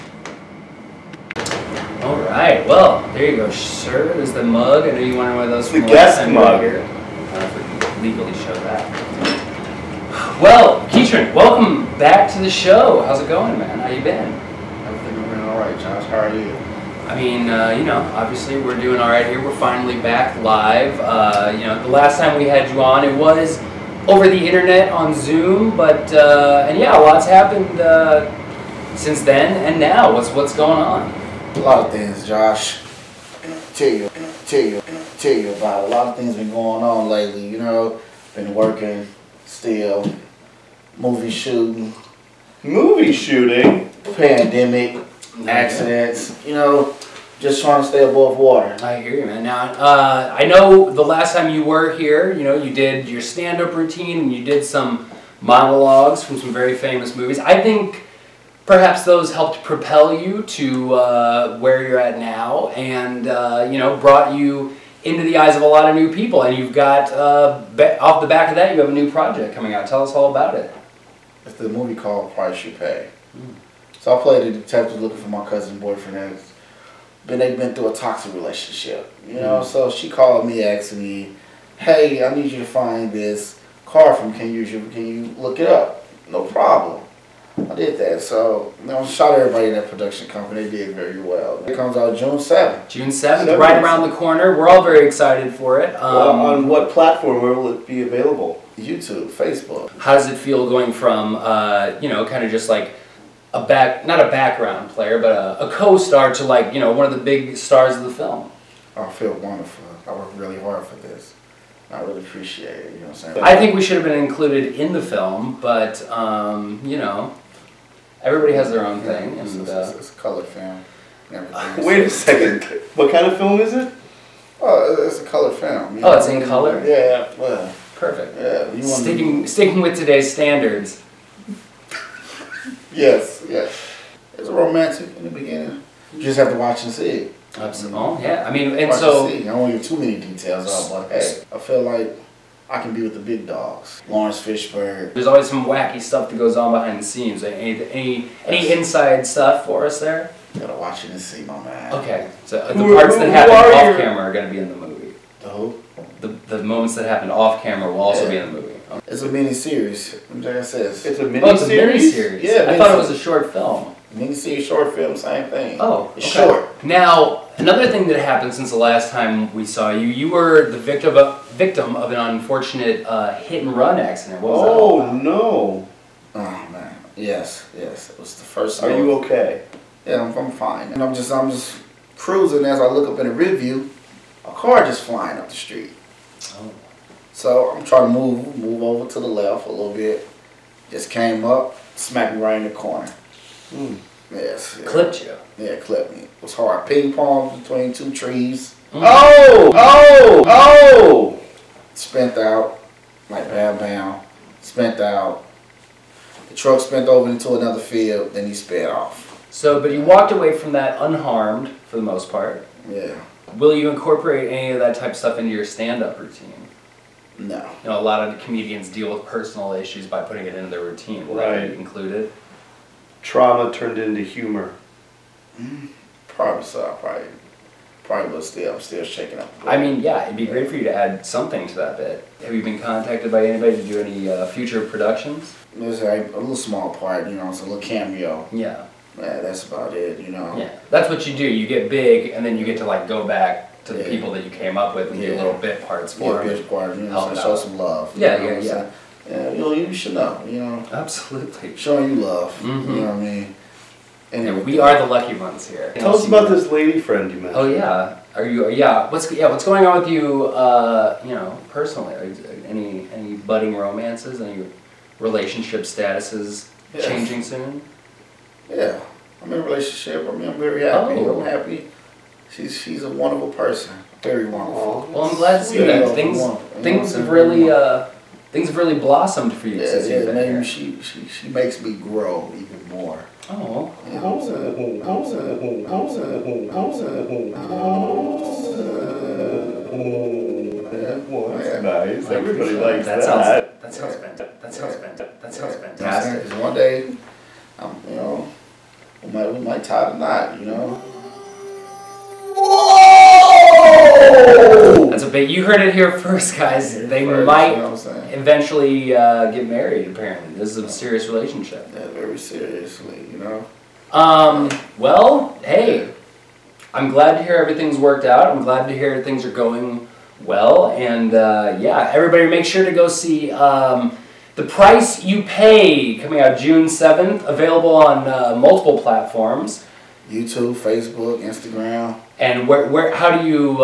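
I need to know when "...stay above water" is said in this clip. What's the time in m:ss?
0:47.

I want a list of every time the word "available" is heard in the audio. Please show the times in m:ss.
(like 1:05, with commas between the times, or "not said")
1:38, 5:27.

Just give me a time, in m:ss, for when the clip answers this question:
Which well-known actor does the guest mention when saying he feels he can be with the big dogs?
2:24.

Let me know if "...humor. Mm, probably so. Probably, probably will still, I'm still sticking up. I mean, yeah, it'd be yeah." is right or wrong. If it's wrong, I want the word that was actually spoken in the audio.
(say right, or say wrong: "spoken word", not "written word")
wrong: "shaking", not "sticking".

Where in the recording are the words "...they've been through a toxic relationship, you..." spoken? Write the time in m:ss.
1:17.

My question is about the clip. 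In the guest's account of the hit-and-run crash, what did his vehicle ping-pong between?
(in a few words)
Two trees.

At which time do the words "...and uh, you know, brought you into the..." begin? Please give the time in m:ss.
1:02.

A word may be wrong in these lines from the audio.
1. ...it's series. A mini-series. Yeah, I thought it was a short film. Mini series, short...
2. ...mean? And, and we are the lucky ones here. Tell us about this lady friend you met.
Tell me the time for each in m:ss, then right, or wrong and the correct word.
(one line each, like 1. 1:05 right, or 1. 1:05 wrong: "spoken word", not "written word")
1. 2:41 right
2. 4:13 right.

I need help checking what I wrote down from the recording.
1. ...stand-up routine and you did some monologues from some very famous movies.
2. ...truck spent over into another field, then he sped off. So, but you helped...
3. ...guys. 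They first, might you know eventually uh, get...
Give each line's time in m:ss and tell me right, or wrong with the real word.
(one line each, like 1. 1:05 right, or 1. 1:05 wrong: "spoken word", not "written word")
1. 0:53 right
2. 3:26 wrong: "walked", not "helped"
3. 5:06 right.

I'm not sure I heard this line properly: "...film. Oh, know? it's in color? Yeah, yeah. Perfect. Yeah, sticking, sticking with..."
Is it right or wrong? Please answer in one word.
right.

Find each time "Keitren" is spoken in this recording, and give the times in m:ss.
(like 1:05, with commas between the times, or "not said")
0:10.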